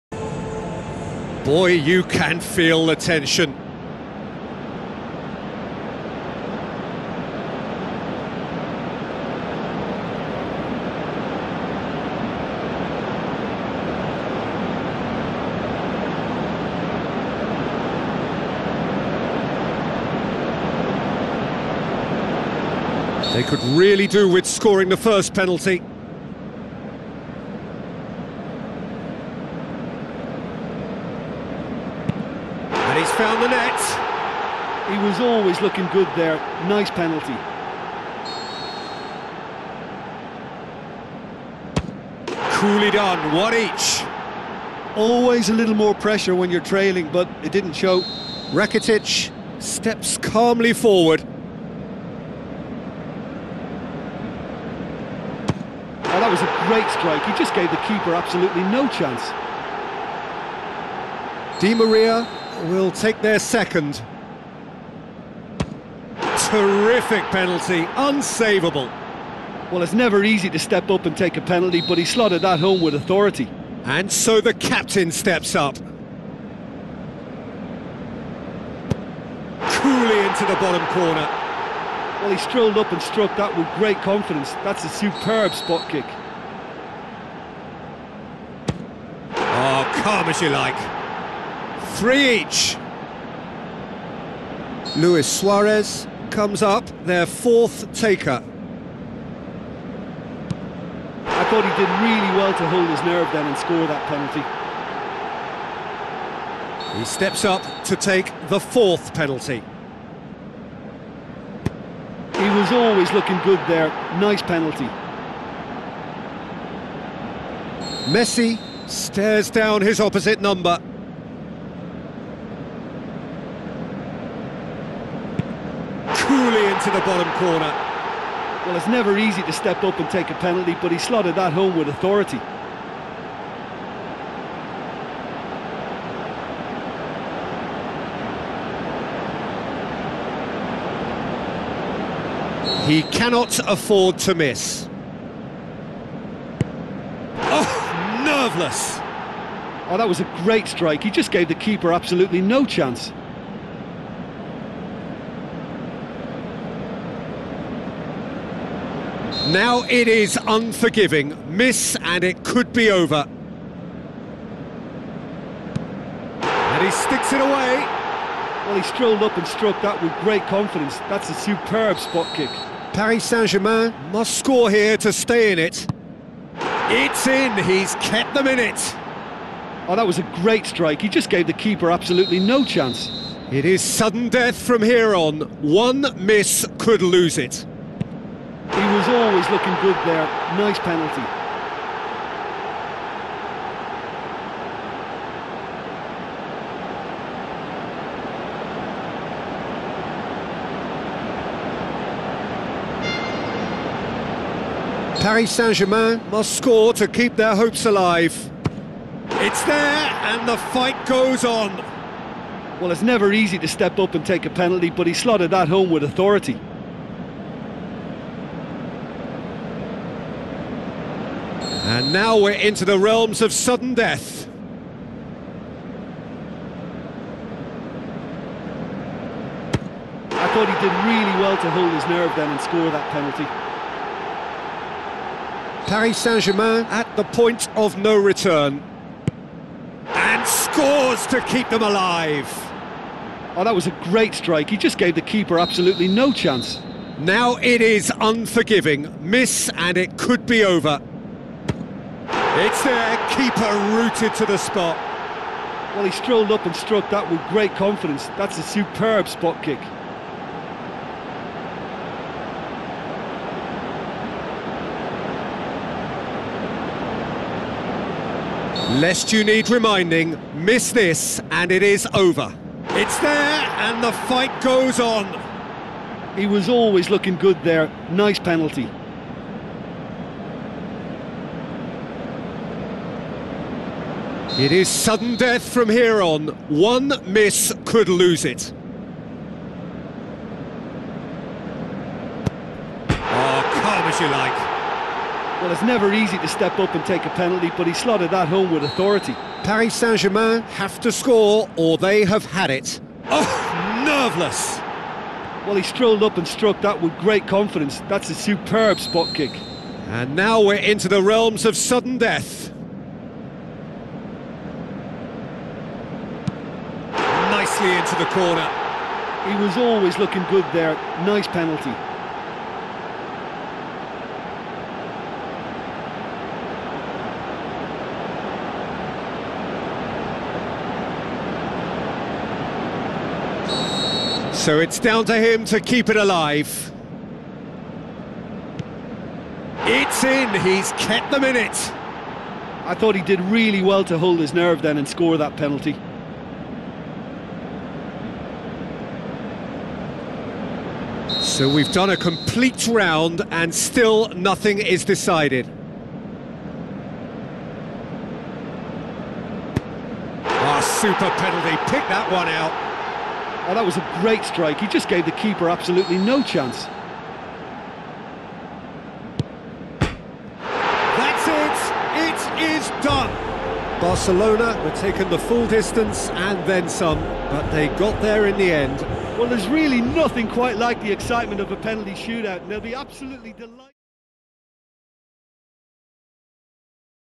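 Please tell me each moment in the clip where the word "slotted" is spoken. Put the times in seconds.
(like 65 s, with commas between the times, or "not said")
72 s, 130 s, 215 s, 297 s.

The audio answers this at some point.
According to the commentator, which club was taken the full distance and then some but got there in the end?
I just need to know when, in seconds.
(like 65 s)
374 s.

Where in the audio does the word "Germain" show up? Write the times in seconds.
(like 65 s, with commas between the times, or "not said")
173 s, 205 s, 236 s, 299 s.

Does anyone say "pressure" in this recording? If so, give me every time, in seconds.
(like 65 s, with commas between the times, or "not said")
45 s.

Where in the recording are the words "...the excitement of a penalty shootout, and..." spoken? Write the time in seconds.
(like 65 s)
381 s.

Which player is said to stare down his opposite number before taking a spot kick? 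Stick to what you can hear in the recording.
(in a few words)
Messi.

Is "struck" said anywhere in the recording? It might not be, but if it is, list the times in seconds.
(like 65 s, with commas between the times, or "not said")
83 s, 169 s, 256 s, 306 s.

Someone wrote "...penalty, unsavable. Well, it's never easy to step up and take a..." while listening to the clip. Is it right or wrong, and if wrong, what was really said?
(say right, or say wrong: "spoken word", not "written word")
right.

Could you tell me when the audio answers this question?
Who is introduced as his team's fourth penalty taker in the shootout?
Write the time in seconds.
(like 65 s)
94 s.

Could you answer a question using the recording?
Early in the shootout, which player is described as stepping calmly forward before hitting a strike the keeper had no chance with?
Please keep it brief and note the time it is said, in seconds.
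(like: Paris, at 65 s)
Rakitic, at 48 s.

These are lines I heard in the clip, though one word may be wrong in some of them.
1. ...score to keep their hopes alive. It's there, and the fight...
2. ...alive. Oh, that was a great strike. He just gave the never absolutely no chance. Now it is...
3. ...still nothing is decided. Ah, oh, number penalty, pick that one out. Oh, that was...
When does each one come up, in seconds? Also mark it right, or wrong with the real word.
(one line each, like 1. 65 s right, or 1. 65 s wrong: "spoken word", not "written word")
1. 206 s right
2. 241 s wrong: "keeper", not "never"
3. 353 s wrong: "super", not "number".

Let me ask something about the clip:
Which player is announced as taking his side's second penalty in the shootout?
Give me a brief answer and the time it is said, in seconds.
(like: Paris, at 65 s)
Di Maria, at 61 s.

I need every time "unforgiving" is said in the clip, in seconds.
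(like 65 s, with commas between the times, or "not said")
160 s, 248 s.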